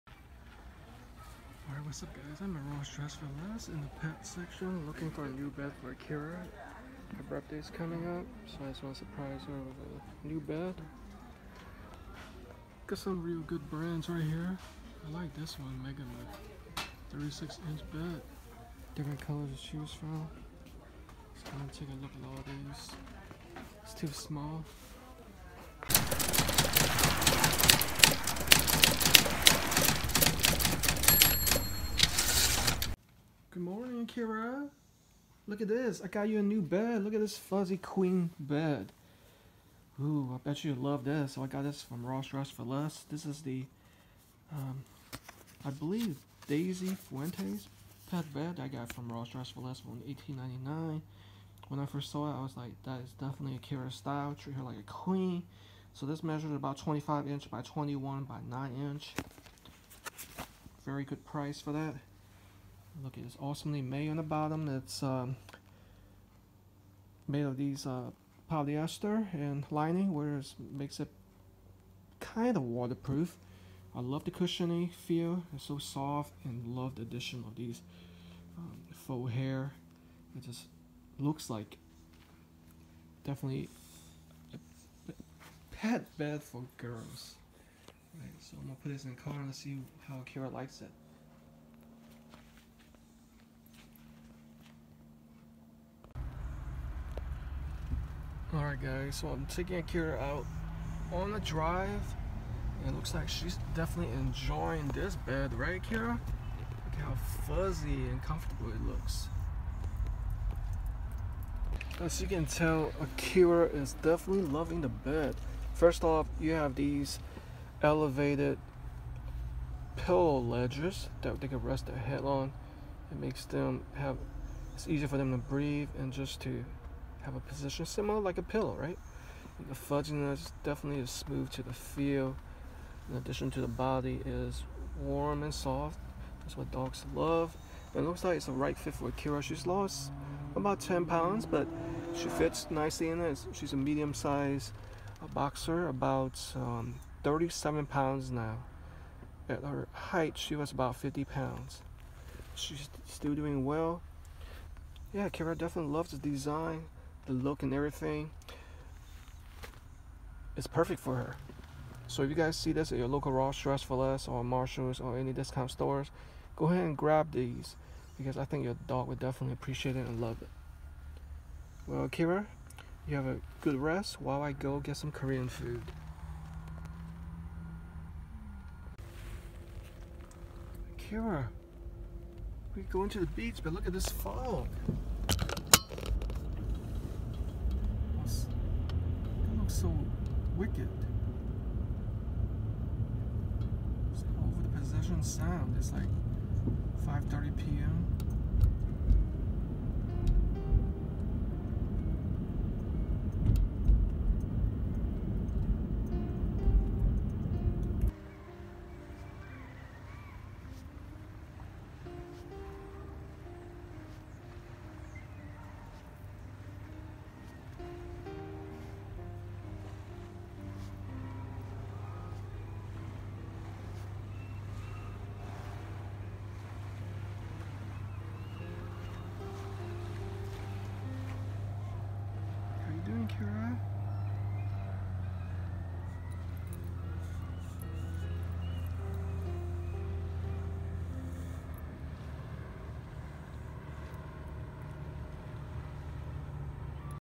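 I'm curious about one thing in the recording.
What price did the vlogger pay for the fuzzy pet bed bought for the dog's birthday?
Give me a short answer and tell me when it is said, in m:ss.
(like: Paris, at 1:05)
$18.99, at 0:49.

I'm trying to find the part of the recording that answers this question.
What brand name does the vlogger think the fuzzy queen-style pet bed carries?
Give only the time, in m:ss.
0:46.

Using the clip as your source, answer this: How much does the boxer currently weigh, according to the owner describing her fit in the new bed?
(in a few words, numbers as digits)
37 pounds.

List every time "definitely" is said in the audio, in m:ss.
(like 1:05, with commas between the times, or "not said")
0:53, 1:23, 1:43, 1:54, 2:10, 2:35, 2:49.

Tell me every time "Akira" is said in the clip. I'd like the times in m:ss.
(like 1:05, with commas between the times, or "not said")
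1:39, 1:45, 1:53.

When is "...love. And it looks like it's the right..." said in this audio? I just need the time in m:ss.
2:17.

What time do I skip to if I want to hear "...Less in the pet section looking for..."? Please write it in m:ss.
0:03.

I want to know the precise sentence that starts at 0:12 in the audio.
Got some real good brands right here.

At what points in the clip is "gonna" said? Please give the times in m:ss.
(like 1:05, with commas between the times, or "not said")
0:21, 1:28.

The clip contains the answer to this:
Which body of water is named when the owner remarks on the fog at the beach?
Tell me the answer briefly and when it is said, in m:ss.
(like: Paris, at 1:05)
Possession Sound, at 3:14.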